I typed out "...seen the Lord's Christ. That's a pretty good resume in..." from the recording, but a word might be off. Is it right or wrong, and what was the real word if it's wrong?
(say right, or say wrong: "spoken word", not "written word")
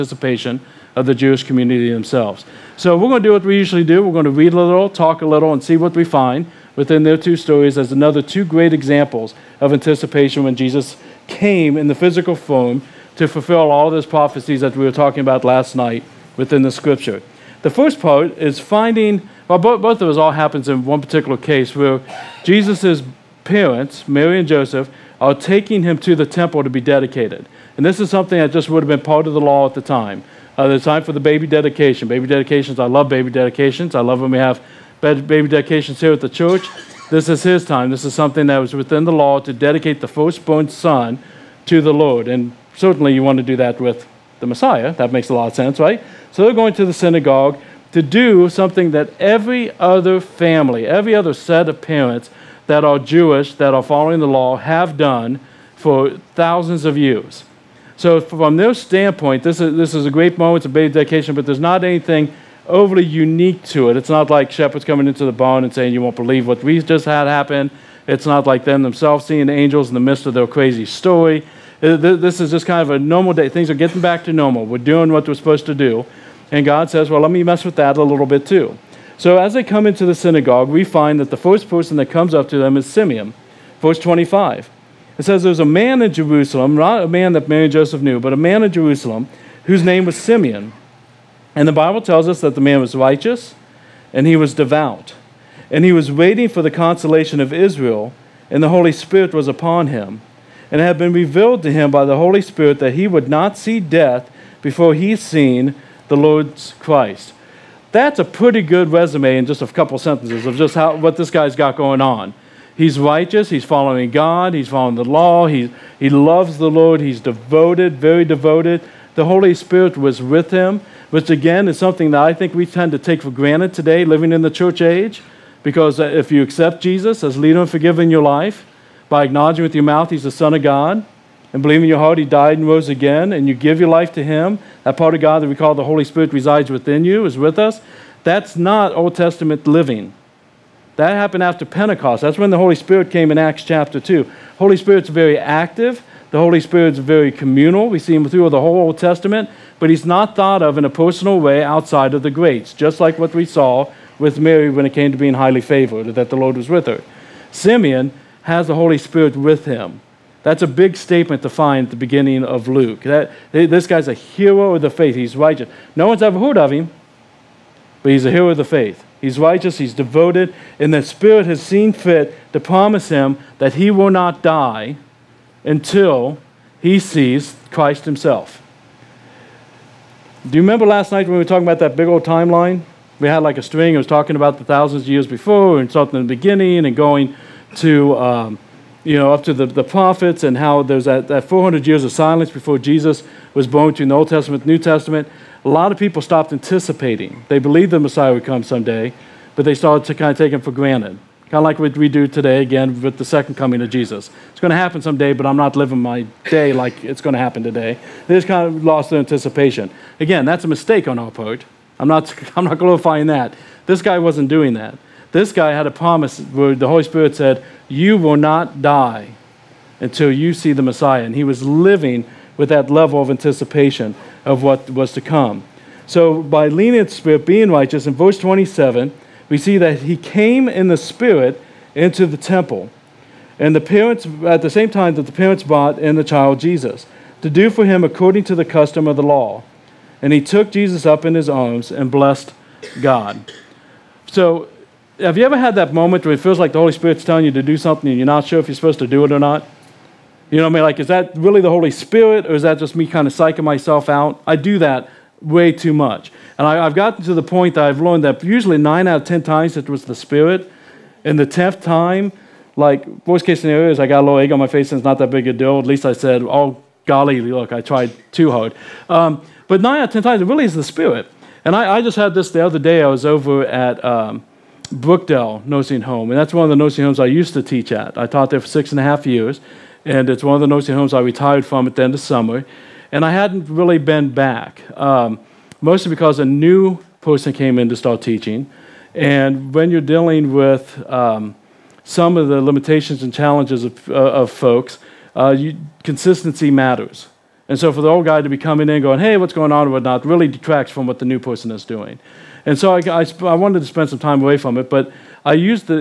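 right.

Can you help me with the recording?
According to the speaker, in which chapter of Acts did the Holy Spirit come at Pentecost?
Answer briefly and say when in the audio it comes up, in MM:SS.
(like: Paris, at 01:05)
Acts chapter 2, at 02:23.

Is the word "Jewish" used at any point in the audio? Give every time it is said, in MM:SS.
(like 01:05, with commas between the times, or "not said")
00:01, 00:52.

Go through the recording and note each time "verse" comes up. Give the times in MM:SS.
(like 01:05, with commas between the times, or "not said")
01:23, 03:48.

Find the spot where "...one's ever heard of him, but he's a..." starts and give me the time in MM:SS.
02:46.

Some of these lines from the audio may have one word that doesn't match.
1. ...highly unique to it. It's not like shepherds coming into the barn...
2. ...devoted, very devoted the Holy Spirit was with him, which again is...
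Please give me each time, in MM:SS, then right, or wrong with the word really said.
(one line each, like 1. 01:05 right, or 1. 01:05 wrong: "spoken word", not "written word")
1. 01:02 wrong: "overly", not "highly"
2. 01:57 right.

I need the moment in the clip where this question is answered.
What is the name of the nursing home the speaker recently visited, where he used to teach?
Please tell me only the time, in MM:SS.
04:34.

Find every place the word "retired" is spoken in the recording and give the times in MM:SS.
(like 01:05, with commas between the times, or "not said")
04:41.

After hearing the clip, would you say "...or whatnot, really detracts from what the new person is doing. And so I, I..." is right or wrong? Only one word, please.
right.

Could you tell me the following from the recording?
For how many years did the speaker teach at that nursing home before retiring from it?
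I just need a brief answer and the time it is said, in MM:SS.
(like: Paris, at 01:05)
6.5 years, at 04:38.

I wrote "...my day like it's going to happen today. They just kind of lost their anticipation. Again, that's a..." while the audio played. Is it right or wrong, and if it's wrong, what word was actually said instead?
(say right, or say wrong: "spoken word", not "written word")
right.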